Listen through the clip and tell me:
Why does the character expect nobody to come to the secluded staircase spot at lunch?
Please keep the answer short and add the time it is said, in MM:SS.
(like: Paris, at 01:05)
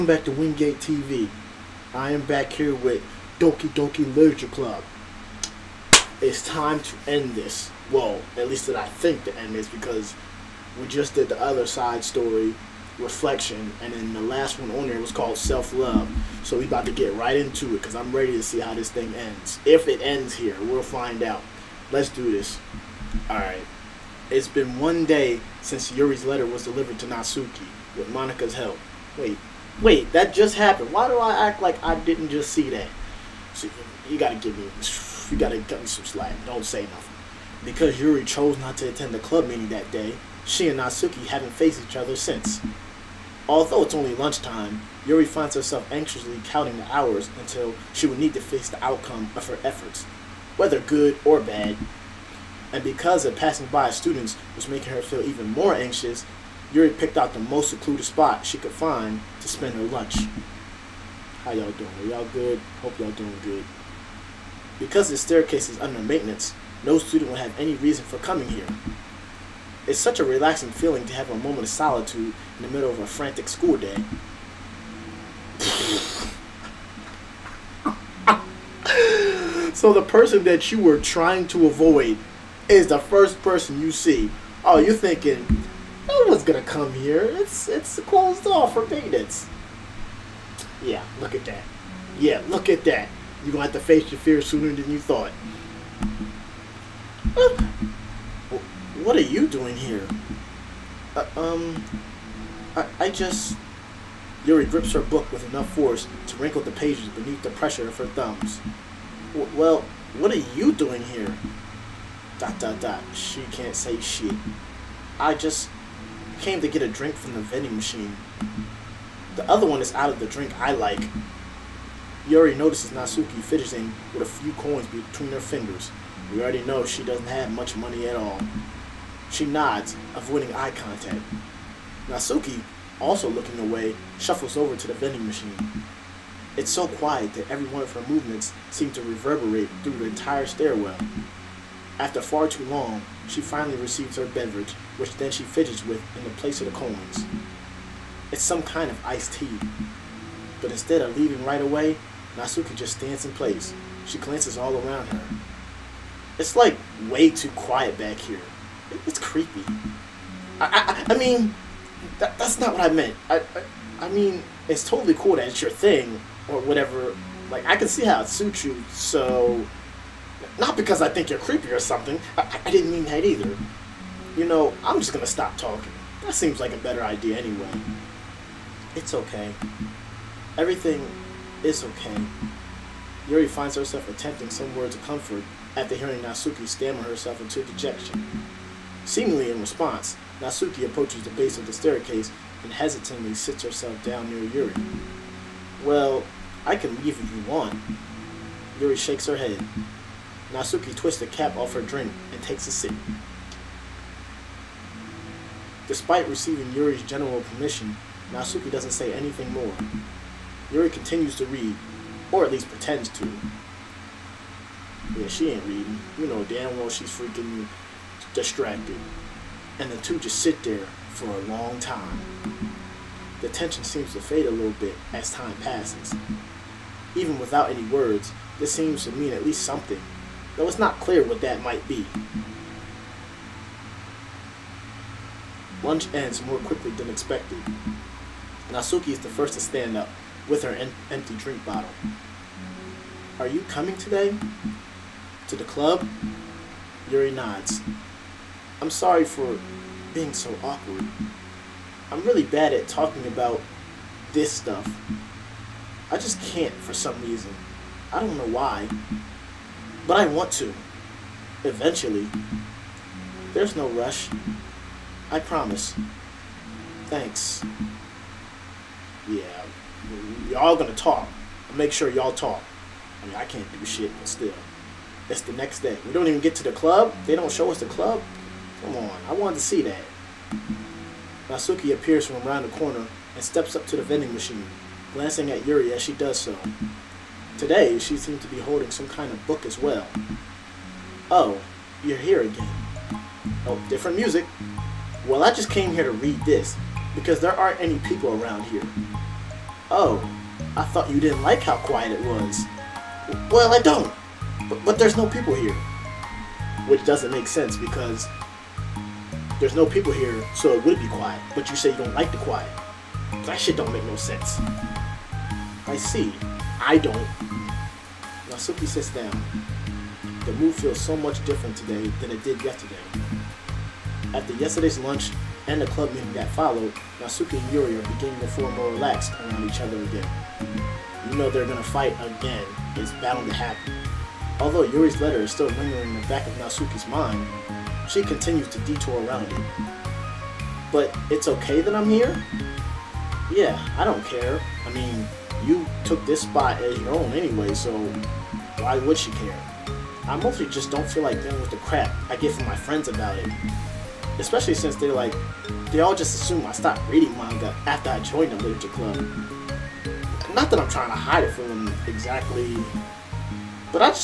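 Under maintenance, at 01:05.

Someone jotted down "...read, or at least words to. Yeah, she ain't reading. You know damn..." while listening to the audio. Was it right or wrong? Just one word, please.
wrong.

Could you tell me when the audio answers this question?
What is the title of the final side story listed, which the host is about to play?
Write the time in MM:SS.
00:15.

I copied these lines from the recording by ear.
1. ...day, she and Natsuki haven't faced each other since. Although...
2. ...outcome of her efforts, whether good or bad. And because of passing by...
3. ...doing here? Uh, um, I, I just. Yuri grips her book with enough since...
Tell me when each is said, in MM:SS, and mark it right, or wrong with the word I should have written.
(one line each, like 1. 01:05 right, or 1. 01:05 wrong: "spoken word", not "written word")
1. 00:39 right
2. 00:48 right
3. 01:39 wrong: "force", not "since".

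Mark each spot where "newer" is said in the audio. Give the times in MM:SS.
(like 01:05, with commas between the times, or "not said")
not said.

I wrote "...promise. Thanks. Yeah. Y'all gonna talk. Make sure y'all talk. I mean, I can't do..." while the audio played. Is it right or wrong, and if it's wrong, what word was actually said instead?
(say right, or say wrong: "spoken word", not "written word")
right.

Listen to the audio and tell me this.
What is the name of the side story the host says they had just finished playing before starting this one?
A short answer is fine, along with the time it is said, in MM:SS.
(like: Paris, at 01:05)
Reflection, at 00:12.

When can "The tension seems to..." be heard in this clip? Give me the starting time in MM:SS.
03:43.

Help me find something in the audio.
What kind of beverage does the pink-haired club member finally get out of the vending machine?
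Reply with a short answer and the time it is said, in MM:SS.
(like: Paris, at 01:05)
Iced tea, at 02:29.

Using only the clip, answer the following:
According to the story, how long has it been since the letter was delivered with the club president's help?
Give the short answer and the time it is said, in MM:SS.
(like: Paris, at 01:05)
1 day, at 00:24.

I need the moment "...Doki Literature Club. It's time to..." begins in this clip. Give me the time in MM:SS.
00:03.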